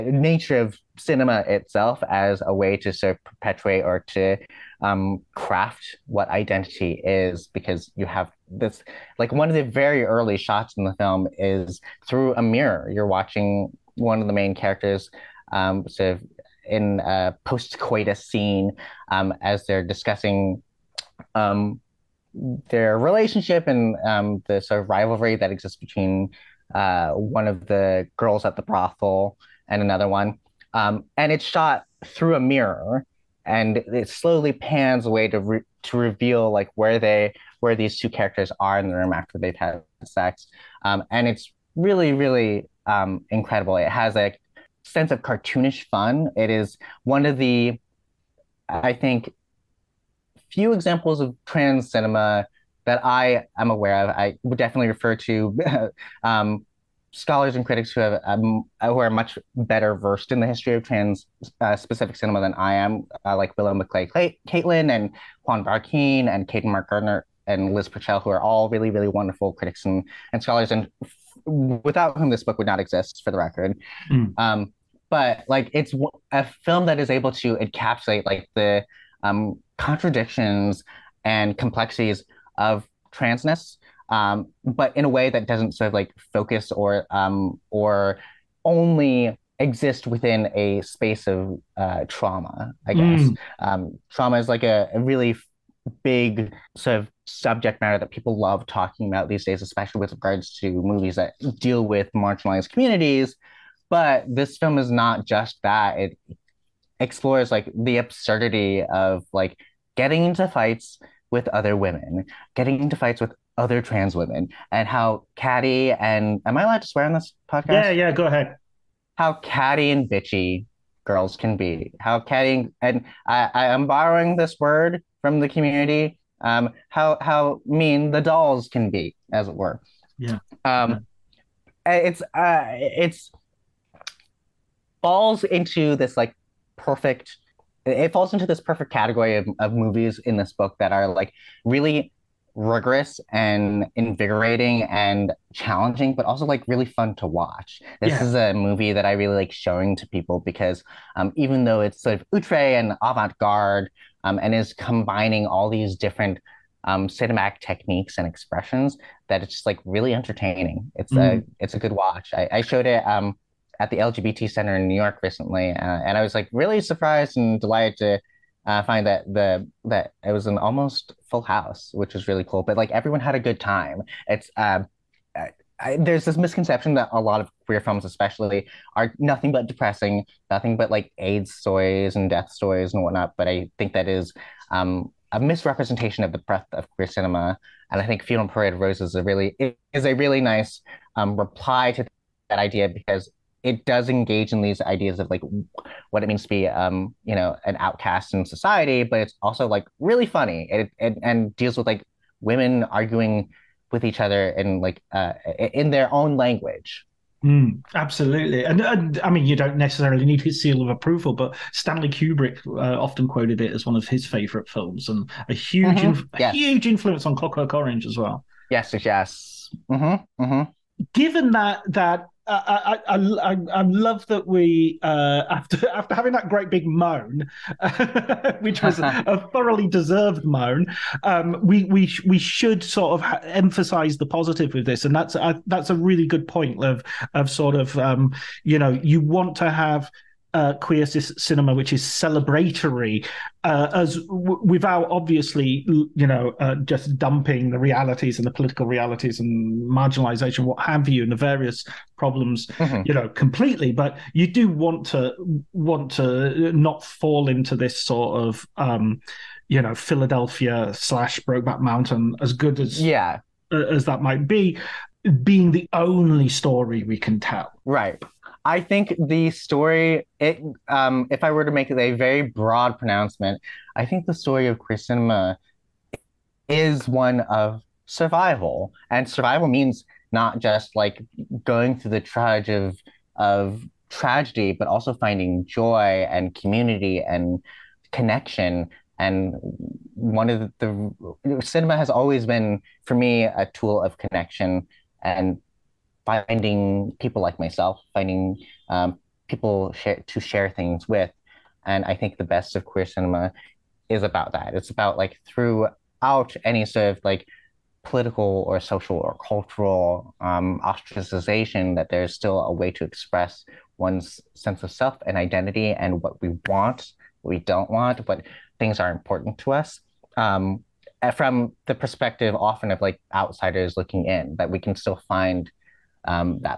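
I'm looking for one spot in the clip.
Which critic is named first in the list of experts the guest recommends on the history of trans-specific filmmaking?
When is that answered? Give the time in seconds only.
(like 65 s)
63 s.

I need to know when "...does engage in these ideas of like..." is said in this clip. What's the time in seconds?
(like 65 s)
193 s.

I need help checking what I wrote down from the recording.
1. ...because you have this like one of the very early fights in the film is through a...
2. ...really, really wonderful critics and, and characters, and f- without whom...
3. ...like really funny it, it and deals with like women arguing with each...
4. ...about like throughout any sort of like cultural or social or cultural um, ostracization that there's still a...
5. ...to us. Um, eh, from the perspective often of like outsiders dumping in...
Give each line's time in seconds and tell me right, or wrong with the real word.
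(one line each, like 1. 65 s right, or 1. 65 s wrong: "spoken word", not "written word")
1. 7 s wrong: "shots", not "fights"
2. 68 s wrong: "scholars", not "characters"
3. 199 s right
4. 304 s wrong: "political", not "cultural"
5. 319 s wrong: "looking", not "dumping".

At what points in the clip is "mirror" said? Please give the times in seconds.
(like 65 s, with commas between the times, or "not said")
12 s, 32 s.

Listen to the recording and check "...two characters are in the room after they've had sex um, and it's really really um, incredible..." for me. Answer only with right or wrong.
right.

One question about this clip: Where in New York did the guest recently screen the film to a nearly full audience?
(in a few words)
The LGBT Center.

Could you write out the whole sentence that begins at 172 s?
But like everyone had a good time.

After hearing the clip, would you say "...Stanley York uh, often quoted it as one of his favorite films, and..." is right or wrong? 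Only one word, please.
wrong.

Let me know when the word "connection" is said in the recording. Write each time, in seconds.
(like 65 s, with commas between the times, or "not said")
288 s, 294 s.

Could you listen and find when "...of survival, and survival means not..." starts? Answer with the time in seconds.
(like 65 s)
277 s.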